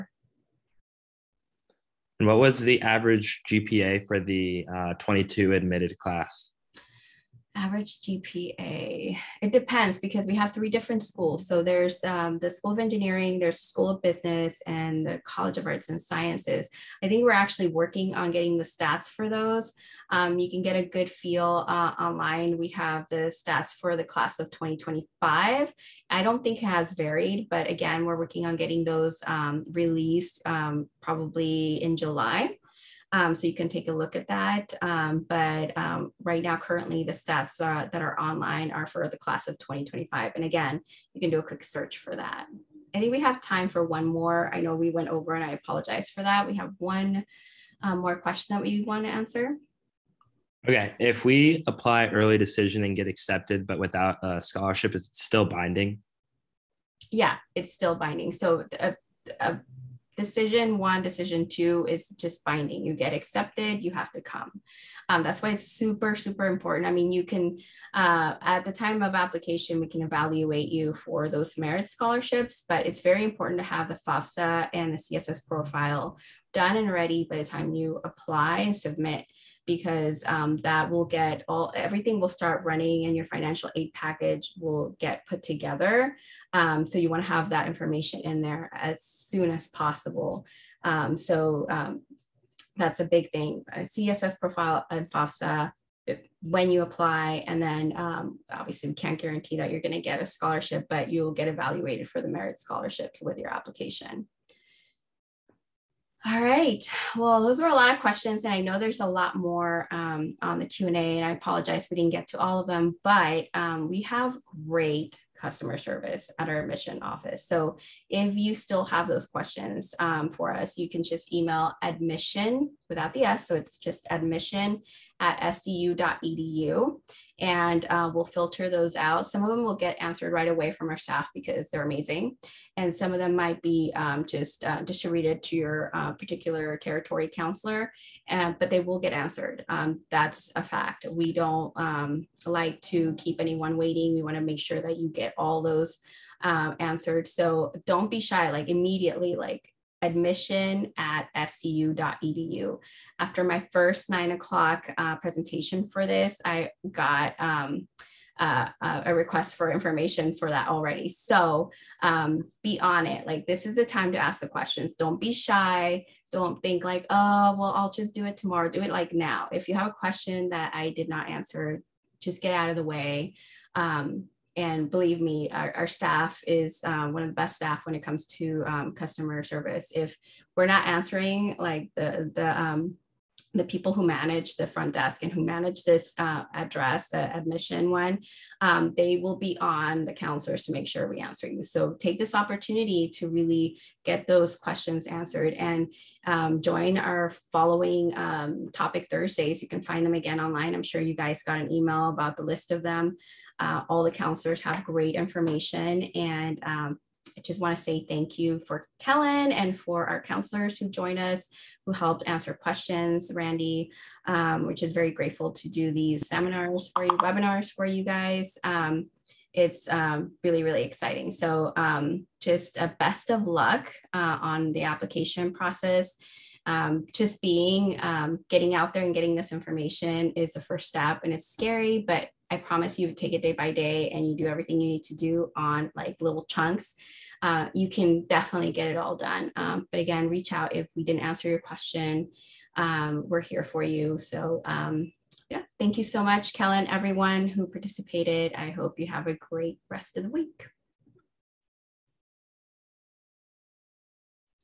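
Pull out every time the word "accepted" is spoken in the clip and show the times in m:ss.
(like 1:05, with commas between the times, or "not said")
0:53, 1:03.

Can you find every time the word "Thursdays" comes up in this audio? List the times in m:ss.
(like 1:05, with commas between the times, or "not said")
3:19.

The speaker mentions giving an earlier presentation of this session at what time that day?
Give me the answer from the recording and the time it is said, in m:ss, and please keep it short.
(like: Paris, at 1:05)
9:00, at 2:34.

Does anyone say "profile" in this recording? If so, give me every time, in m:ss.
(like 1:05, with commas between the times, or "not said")
1:15, 1:34.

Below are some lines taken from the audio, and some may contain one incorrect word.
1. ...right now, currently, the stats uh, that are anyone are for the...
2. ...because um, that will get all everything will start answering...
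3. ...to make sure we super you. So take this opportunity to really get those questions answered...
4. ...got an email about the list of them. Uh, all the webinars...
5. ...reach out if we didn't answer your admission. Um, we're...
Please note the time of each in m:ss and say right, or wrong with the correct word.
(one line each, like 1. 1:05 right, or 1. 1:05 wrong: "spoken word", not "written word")
1. 0:36 wrong: "online", not "anyone"
2. 1:19 wrong: "running", not "answering"
3. 3:10 wrong: "answer", not "super"
4. 3:21 wrong: "counselors", not "webinars"
5. 4:00 wrong: "question", not "admission".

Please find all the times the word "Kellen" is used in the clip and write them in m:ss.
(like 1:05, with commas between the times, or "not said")
3:28, 4:06.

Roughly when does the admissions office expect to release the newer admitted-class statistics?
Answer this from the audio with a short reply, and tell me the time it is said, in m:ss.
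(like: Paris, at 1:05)
July, at 0:31.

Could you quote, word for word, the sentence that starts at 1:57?
So if you still have those questions um, for us, you can just email admission without the S.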